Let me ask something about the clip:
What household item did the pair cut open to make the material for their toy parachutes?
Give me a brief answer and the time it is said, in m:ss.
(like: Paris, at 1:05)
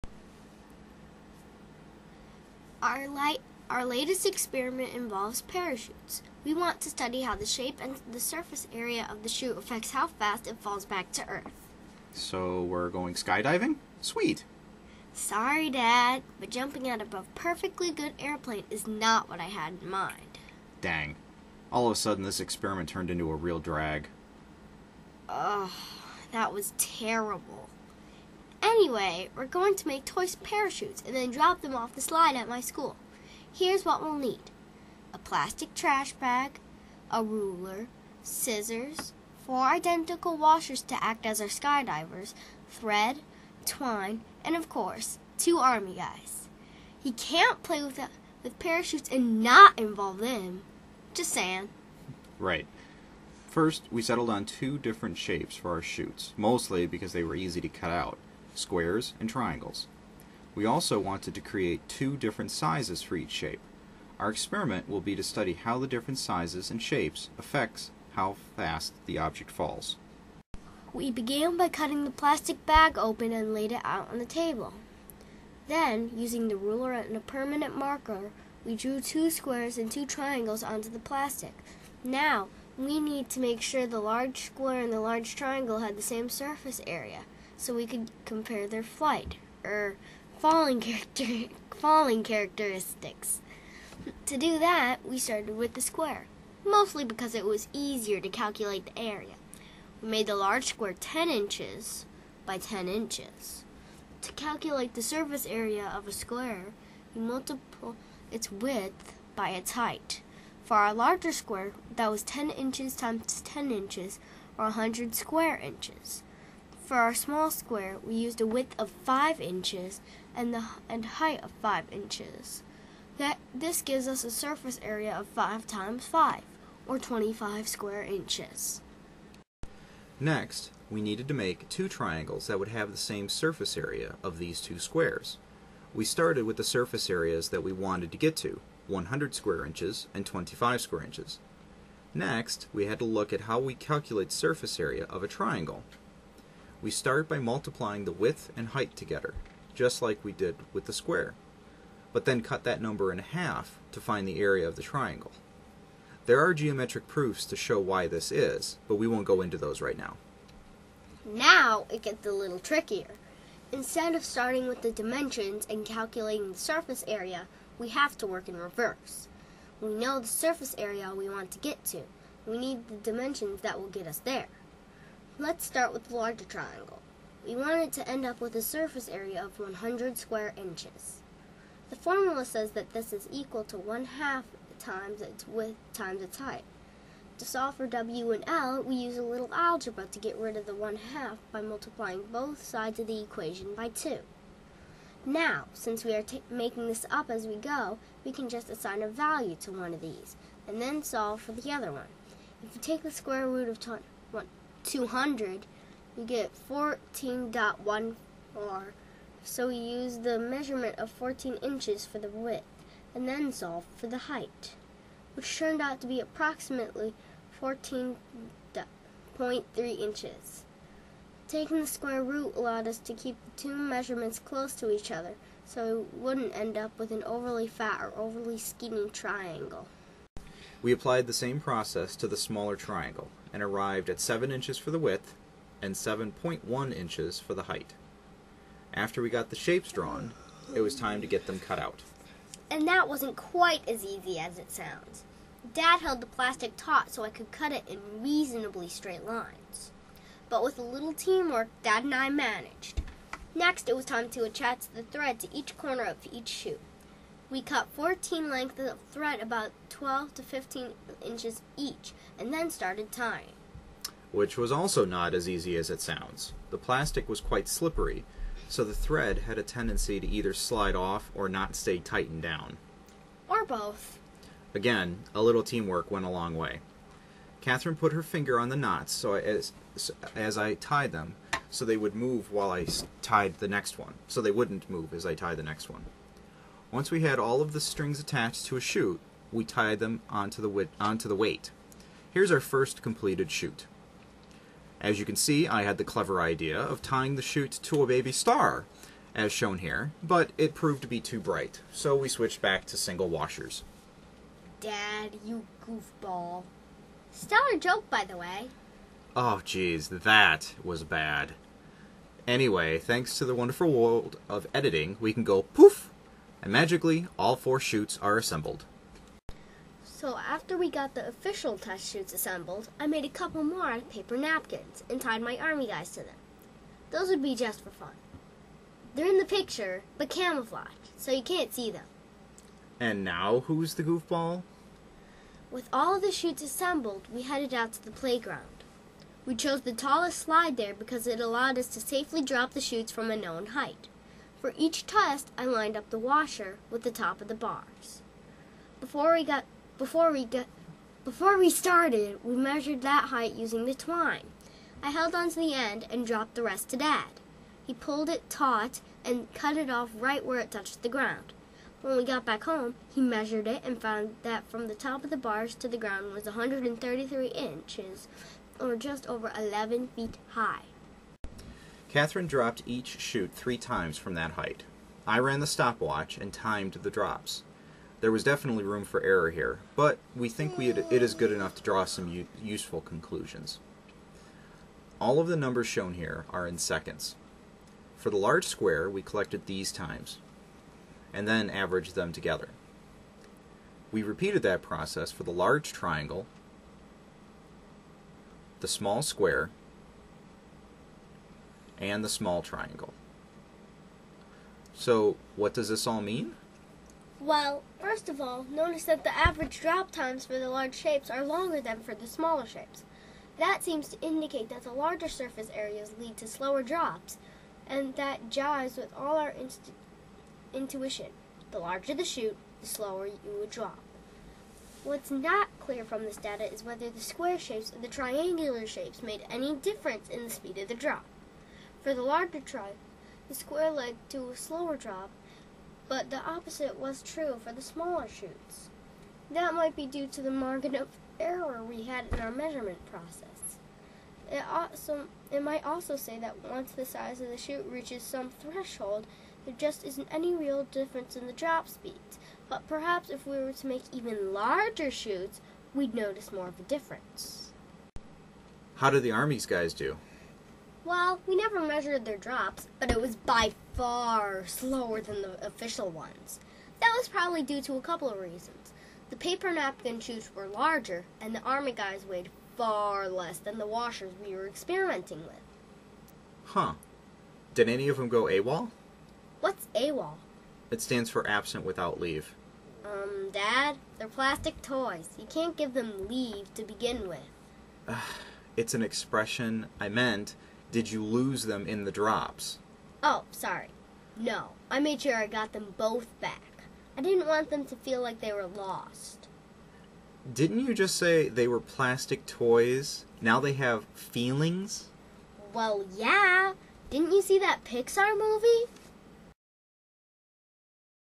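plastic trash bag, at 0:35.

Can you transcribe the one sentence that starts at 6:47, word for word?
Well, first of all, notice that the average drop times for the large shapes are longer than for the smaller shapes.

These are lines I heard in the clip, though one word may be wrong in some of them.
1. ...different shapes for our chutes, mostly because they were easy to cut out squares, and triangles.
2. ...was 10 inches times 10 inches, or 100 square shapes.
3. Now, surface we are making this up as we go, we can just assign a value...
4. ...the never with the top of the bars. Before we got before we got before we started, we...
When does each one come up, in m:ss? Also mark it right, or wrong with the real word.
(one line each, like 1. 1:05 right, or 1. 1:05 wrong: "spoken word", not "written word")
1. 0:54 right
2. 1:52 wrong: "inches", not "shapes"
3. 3:15 wrong: "since", not "surface"
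4. 5:46 wrong: "washer", not "never".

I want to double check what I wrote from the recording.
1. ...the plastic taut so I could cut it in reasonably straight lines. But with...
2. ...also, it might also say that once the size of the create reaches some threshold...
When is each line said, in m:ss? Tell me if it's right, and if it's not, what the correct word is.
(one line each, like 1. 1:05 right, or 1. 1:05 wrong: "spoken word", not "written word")
1. 4:06 right
2. 7:24 wrong: "chute", not "create".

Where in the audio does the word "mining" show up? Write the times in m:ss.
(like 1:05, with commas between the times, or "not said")
not said.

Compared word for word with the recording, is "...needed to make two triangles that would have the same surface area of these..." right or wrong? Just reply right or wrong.
right.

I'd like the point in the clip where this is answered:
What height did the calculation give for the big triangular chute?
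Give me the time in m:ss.
3:37.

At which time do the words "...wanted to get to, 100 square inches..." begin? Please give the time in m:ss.
2:17.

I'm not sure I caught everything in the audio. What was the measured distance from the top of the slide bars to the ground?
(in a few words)
133 inches.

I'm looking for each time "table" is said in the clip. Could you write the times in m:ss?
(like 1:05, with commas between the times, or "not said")
1:14.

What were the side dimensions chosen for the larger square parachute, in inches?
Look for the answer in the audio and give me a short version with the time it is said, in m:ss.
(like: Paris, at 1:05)
10 inches by 10 inches, at 1:40.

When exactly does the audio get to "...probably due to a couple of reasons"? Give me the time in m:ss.
7:47.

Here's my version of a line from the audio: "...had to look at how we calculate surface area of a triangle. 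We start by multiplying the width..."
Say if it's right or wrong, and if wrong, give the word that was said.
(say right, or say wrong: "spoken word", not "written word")
right.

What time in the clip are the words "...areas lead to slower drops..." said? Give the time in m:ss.
6:55.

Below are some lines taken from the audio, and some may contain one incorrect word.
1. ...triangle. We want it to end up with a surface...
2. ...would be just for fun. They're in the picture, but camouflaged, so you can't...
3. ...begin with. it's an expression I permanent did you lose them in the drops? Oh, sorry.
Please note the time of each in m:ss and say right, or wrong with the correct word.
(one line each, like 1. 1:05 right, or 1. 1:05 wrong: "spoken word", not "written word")
1. 2:56 right
2. 5:27 right
3. 8:06 wrong: "meant", not "permanent".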